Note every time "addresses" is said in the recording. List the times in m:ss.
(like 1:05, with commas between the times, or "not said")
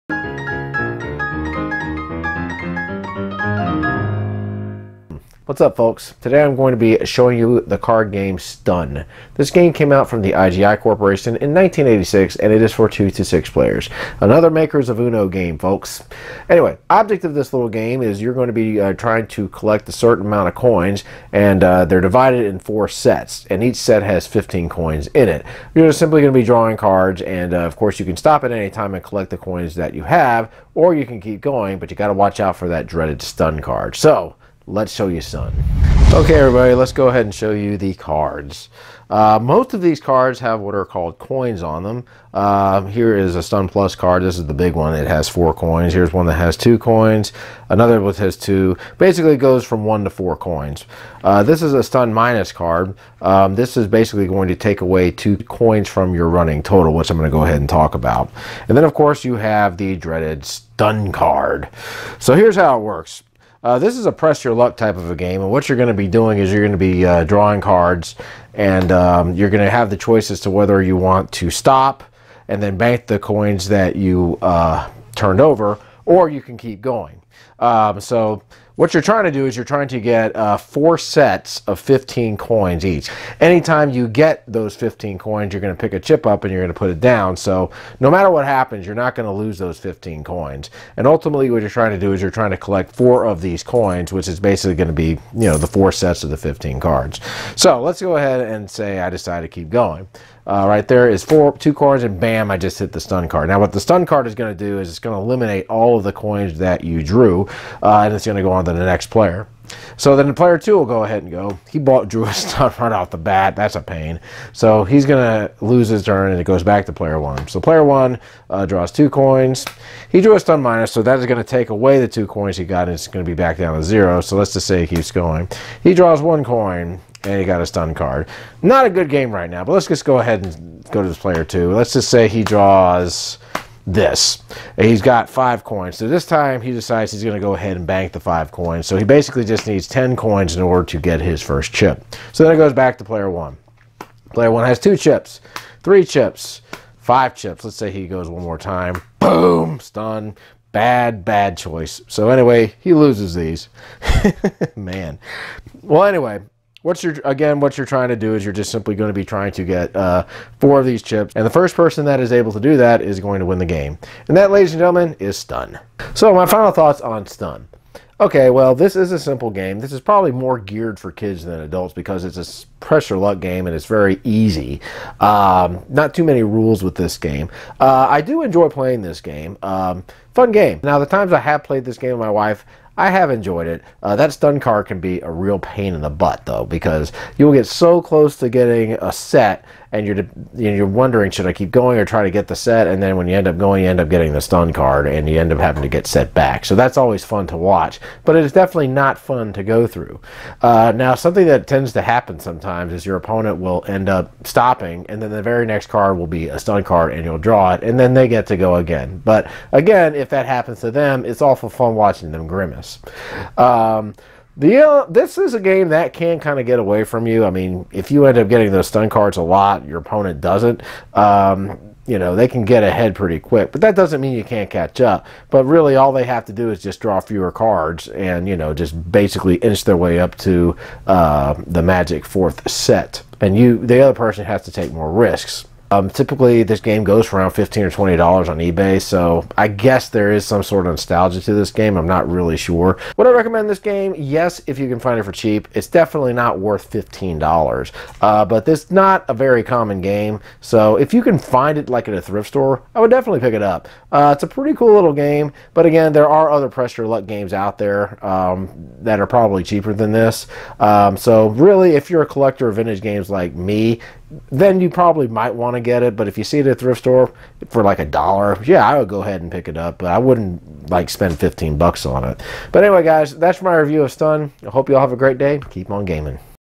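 not said.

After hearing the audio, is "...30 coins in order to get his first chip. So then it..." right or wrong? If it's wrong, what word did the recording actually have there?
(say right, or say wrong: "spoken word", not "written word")
wrong: "10", not "30".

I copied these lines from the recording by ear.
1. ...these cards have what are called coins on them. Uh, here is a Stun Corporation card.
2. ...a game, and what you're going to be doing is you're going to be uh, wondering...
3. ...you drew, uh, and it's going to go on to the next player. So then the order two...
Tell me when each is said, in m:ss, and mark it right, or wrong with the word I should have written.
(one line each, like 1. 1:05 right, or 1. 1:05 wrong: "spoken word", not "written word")
1. 0:39 wrong: "Plus", not "Corporation"
2. 1:05 wrong: "drawing", not "wondering"
3. 1:46 wrong: "player", not "order".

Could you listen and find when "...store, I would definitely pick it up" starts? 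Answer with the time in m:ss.
4:12.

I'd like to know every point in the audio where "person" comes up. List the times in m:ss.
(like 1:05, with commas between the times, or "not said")
2:41, 3:54.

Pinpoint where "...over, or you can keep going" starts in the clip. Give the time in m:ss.
1:15.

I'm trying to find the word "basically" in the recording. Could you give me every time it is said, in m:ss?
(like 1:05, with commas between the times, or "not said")
0:48, 0:53, 1:34, 2:19, 3:49.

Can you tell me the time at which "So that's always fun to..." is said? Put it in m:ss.
3:16.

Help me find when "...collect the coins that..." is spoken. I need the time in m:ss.
0:29.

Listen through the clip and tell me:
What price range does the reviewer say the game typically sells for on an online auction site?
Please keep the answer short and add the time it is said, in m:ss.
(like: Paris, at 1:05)
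$15 to $20, at 3:57.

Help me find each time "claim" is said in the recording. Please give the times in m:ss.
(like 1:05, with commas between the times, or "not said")
not said.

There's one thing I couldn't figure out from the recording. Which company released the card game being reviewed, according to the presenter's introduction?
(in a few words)
IGI Corporation.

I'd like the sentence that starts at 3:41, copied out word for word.
Um, you know, they can get ahead pretty quick.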